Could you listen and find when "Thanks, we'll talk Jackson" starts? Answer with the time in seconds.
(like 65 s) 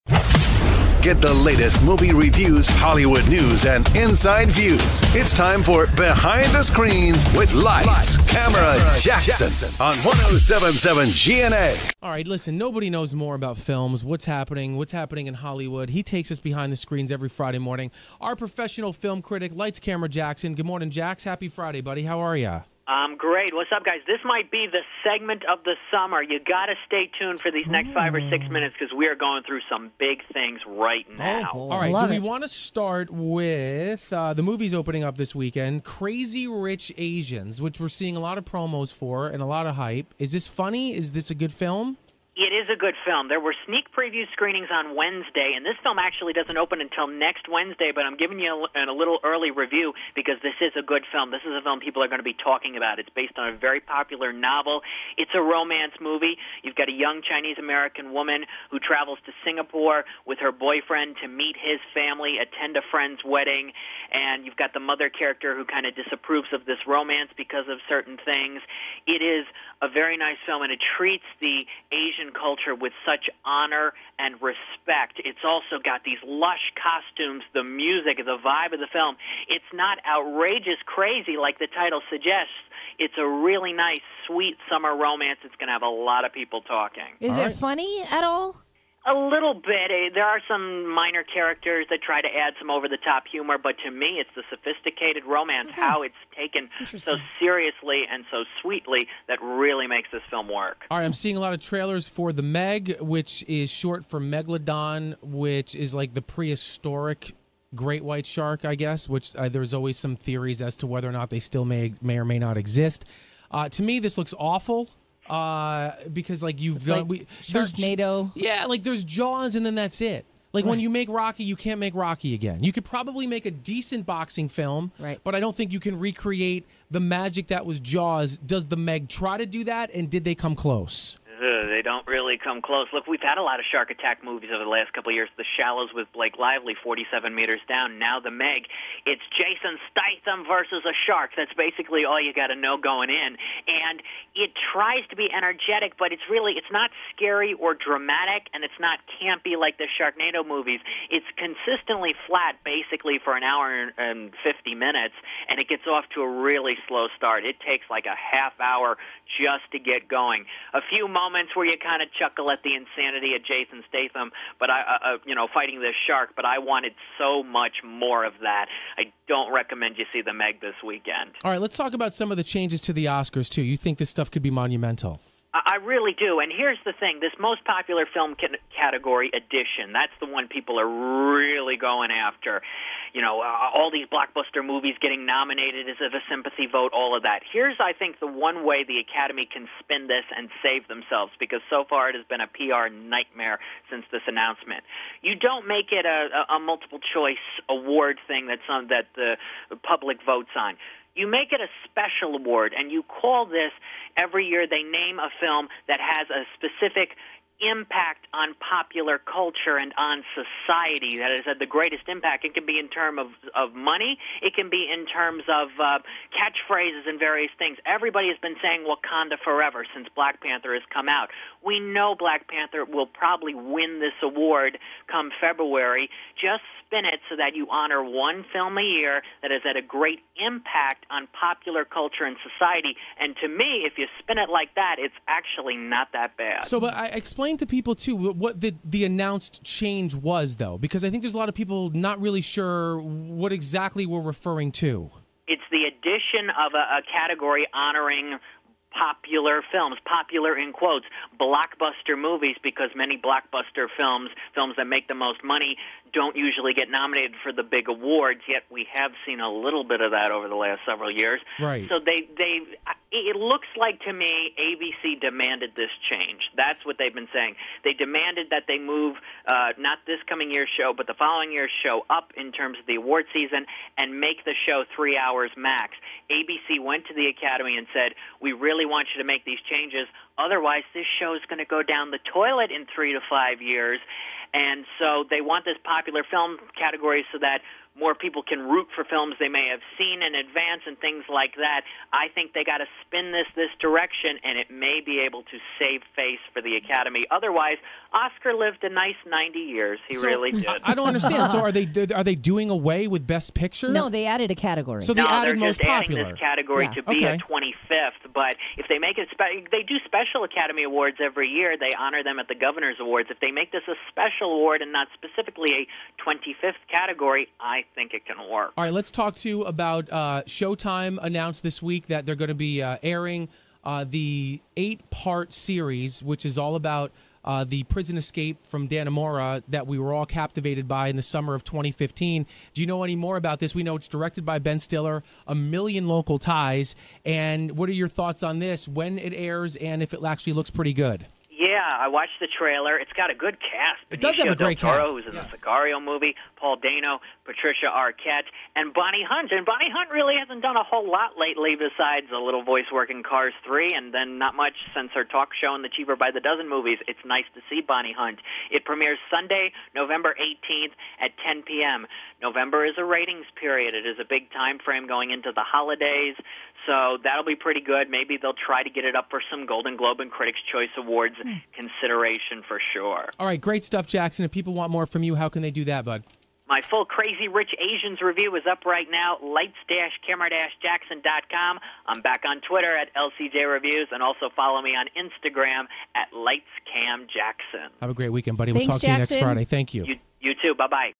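388 s.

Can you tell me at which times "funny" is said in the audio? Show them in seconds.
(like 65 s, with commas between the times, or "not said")
40 s, 87 s.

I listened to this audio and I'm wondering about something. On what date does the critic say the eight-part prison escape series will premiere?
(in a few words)
November 18th.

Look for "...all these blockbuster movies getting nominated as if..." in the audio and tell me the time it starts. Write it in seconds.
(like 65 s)
183 s.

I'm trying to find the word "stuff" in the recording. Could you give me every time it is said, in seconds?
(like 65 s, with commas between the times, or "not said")
174 s, 373 s.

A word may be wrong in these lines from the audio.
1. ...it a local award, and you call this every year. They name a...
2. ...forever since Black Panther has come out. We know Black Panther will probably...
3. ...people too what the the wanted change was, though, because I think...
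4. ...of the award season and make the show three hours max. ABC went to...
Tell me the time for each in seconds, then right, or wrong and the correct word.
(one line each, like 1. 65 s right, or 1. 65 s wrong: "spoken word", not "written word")
1. 201 s wrong: "special", not "local"
2. 219 s right
3. 237 s wrong: "announced", not "wanted"
4. 272 s right.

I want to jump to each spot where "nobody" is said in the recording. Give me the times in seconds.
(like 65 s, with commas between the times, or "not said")
12 s.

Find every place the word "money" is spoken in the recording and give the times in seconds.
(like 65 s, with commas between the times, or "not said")
213 s, 255 s.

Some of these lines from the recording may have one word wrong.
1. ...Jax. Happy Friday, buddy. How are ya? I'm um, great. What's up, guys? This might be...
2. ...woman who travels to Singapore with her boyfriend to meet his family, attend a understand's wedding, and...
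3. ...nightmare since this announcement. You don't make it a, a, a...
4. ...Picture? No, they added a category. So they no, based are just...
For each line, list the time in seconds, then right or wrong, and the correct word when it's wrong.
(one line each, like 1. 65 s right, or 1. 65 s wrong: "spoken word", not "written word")
1. 20 s right
2. 58 s wrong: "friend", not "understand"
3. 192 s right
4. 303 s wrong: "added", not "based".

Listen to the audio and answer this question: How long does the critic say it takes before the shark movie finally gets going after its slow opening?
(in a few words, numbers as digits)
half hour.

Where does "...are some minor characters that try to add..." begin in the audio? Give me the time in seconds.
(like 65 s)
90 s.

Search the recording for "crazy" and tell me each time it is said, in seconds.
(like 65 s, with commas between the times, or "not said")
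35 s, 80 s, 377 s.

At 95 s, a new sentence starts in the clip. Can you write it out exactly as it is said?
how it's taken so seriously and so sweetly, that really makes this film work.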